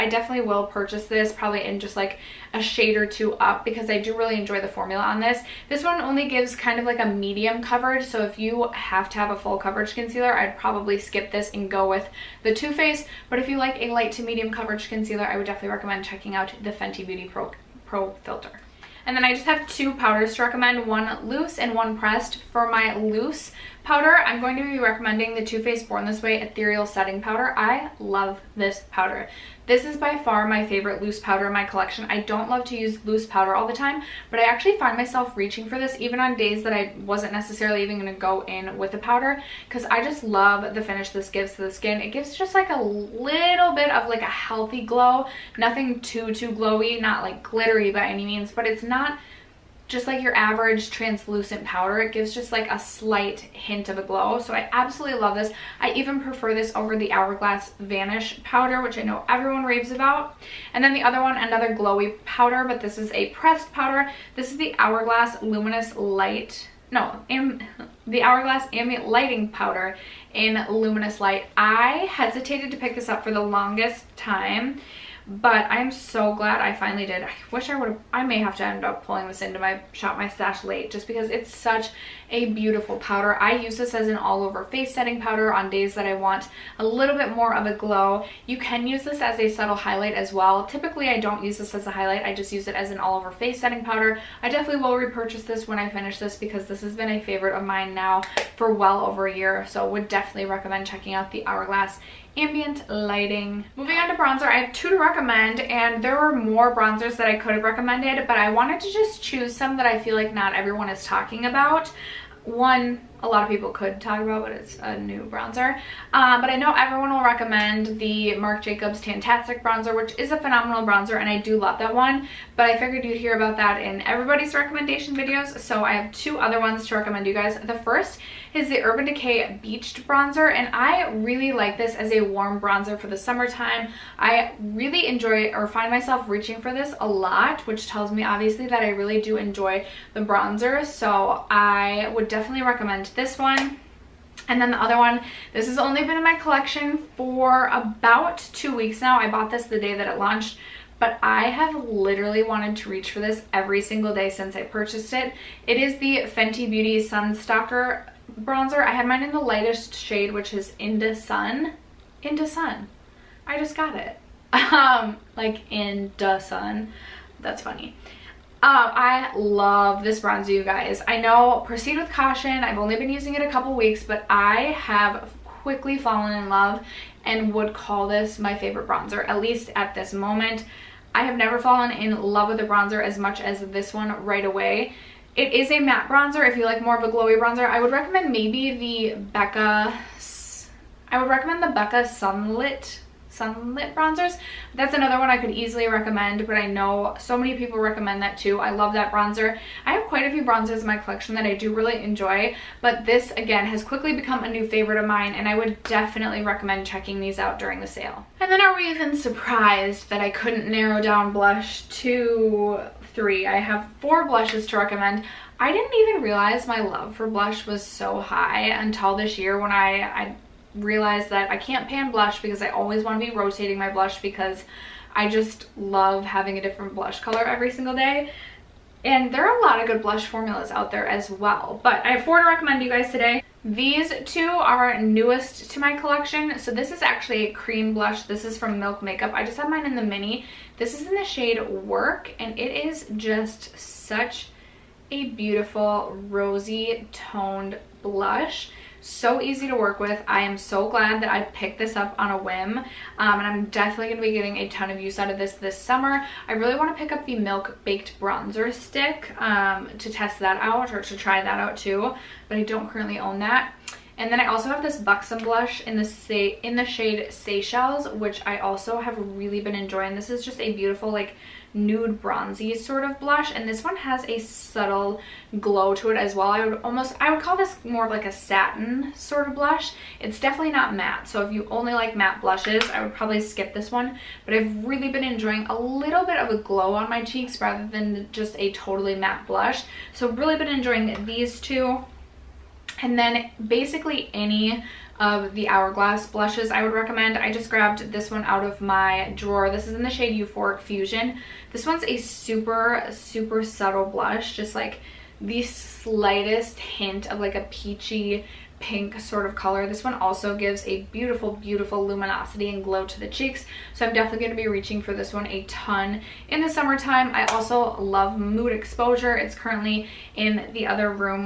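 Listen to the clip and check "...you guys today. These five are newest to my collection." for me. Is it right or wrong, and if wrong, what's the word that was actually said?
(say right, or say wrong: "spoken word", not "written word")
wrong: "two", not "five".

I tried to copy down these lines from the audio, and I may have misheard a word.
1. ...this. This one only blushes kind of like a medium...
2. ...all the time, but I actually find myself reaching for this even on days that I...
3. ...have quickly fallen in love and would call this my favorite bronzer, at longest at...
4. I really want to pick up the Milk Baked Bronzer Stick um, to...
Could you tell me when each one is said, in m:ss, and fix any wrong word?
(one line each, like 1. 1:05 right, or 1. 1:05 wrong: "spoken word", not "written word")
1. 0:05 wrong: "gives", not "blushes"
2. 0:33 right
3. 2:54 wrong: "least", not "longest"
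4. 4:16 right.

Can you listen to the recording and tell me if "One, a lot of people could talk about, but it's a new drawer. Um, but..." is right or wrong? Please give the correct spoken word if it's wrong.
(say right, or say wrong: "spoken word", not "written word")
wrong: "bronzer", not "drawer".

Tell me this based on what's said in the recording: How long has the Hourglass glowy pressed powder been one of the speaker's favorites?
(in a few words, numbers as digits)
well over a year.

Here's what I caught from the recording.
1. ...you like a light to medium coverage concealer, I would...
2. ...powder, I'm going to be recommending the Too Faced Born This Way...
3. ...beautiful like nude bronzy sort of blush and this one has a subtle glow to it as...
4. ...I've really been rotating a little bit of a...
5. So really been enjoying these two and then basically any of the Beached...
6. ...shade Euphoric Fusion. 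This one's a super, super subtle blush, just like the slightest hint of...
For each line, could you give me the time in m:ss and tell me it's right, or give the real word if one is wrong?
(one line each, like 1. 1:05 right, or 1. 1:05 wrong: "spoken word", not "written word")
1. 0:13 right
2. 0:23 right
3. 4:30 right
4. 4:44 wrong: "enjoying", not "rotating"
5. 4:50 wrong: "Hourglass", not "Beached"
6. 5:00 right.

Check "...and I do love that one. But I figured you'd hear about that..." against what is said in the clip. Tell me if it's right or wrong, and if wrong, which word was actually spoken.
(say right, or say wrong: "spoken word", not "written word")
right.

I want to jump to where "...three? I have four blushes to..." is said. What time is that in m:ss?
3:33.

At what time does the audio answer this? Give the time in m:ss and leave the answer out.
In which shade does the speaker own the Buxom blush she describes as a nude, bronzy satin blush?
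4:27.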